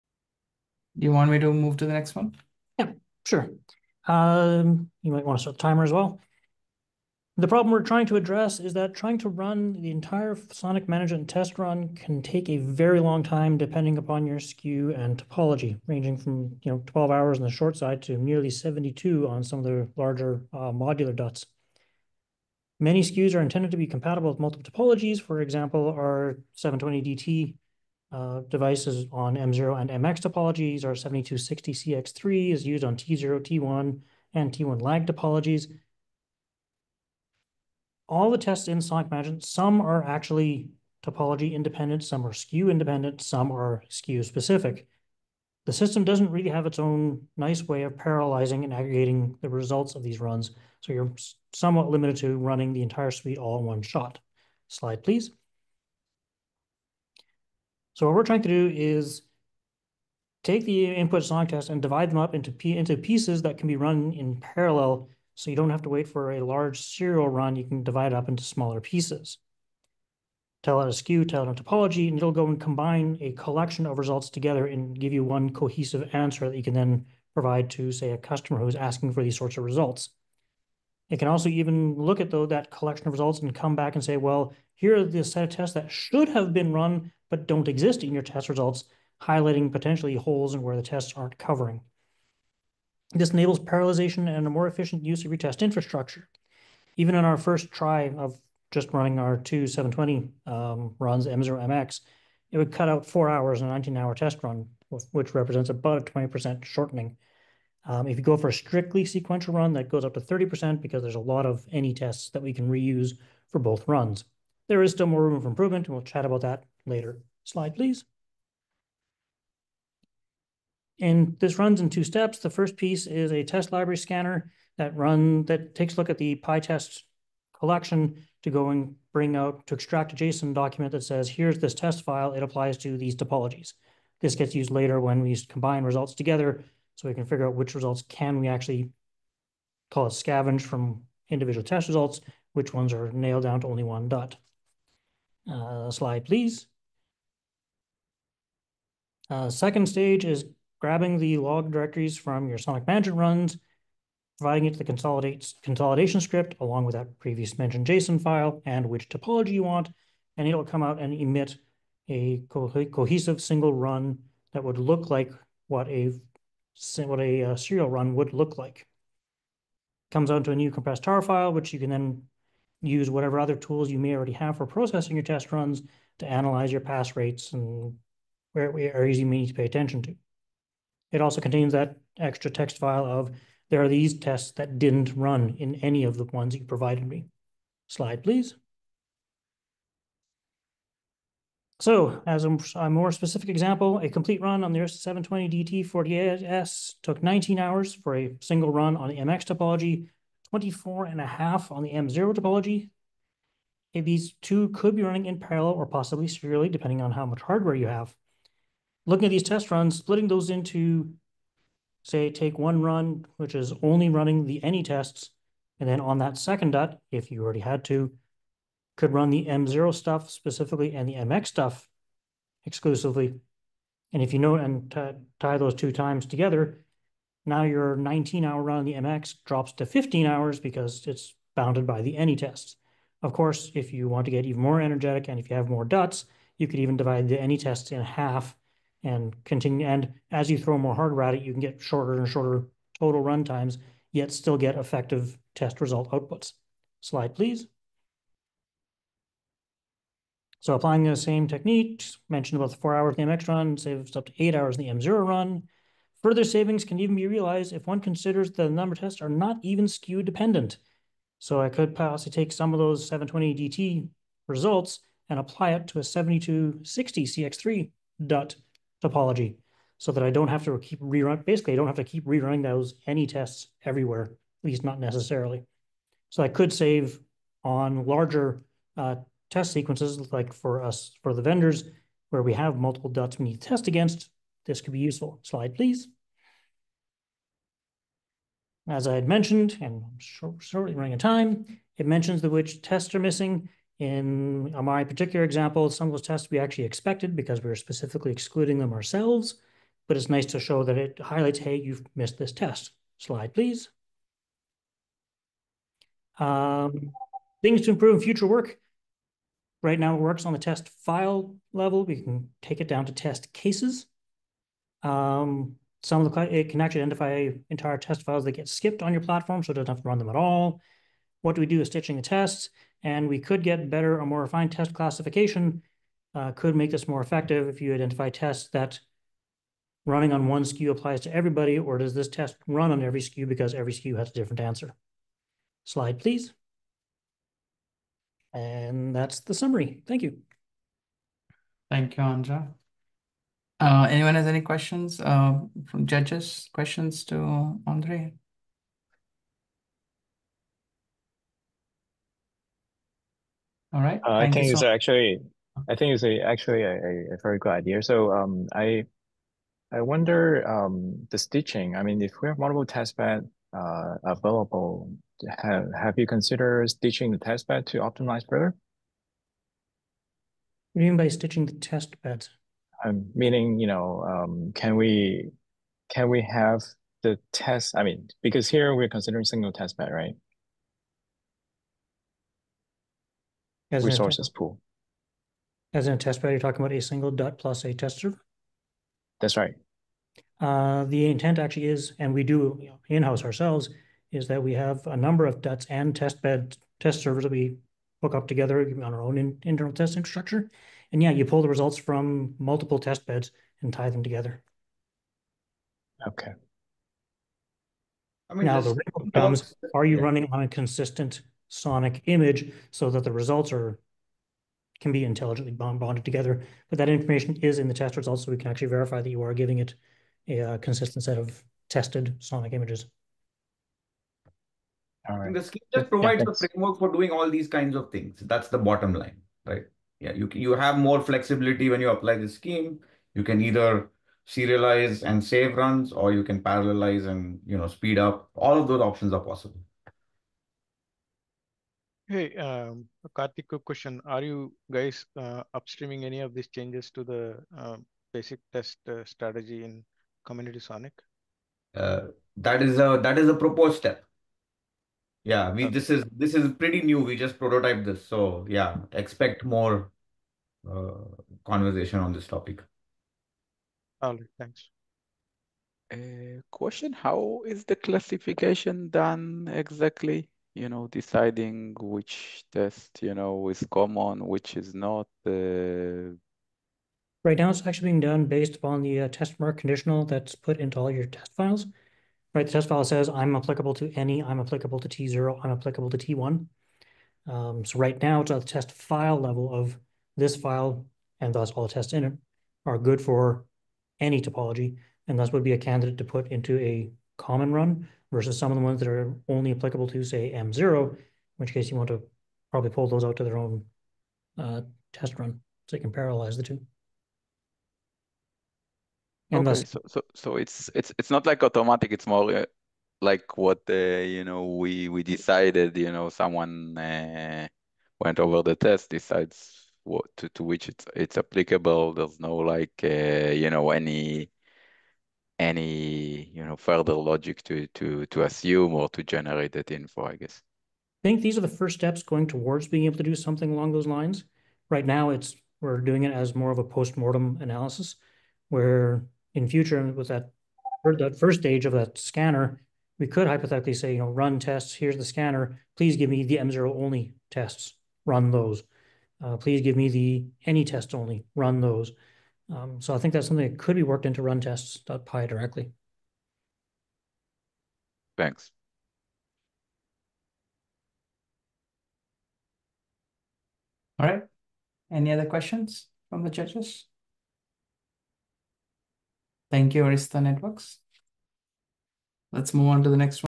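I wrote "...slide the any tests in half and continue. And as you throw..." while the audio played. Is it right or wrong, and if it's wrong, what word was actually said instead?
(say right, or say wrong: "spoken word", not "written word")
wrong: "divide", not "slide".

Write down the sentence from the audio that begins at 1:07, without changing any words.
You can divide it up into smaller pieces.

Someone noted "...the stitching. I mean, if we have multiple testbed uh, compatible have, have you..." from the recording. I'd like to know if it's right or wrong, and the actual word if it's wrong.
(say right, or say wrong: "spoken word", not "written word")
wrong: "available", not "compatible".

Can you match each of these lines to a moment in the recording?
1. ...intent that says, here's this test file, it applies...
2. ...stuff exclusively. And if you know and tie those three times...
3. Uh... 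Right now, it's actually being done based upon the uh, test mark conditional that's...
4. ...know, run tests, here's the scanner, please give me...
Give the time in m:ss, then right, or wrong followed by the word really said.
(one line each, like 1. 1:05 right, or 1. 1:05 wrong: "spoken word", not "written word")
1. 2:10 wrong: "document", not "intent"
2. 3:41 wrong: "two", not "three"
3. 7:55 right
4. 9:04 right.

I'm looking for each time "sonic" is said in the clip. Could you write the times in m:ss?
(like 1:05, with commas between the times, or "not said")
0:10, 0:38, 2:32, 6:51, 7:02, 7:30.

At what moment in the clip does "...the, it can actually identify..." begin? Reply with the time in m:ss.
5:16.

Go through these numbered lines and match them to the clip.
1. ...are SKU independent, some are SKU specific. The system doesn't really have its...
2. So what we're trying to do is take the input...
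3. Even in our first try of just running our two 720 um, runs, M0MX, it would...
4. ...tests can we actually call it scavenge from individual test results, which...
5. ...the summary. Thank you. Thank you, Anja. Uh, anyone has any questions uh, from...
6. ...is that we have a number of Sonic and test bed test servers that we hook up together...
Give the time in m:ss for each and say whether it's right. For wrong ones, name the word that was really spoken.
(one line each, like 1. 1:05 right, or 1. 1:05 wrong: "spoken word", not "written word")
1. 0:42 right
2. 0:58 right
3. 1:36 right
4. 2:17 wrong: "results", not "tests"
5. 5:39 right
6. 6:34 wrong: "DUTs", not "Sonic".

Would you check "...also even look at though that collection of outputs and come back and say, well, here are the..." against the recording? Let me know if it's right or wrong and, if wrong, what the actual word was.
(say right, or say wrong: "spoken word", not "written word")
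wrong: "results", not "outputs".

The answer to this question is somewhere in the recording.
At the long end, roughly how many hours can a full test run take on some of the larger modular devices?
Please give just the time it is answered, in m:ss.
0:18.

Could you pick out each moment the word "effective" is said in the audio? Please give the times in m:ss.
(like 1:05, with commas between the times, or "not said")
4:04, 5:27.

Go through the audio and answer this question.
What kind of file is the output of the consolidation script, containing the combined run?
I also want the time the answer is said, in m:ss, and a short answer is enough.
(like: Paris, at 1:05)
compressed tar file, at 2:50.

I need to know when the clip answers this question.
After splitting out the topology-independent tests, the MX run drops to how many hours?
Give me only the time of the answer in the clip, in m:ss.
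3:49.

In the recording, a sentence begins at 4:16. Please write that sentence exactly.
Further savings can even be realized if one considers that the number tests are not even SKU dependent.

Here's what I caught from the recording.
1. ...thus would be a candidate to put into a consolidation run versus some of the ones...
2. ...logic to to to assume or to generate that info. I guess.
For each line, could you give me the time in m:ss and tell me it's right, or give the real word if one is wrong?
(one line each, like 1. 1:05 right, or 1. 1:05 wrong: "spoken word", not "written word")
1. 8:15 wrong: "common", not "consolidation"
2. 8:47 right.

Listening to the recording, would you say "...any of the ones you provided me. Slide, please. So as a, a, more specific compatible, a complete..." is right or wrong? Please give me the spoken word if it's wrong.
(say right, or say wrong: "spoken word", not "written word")
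wrong: "example", not "compatible".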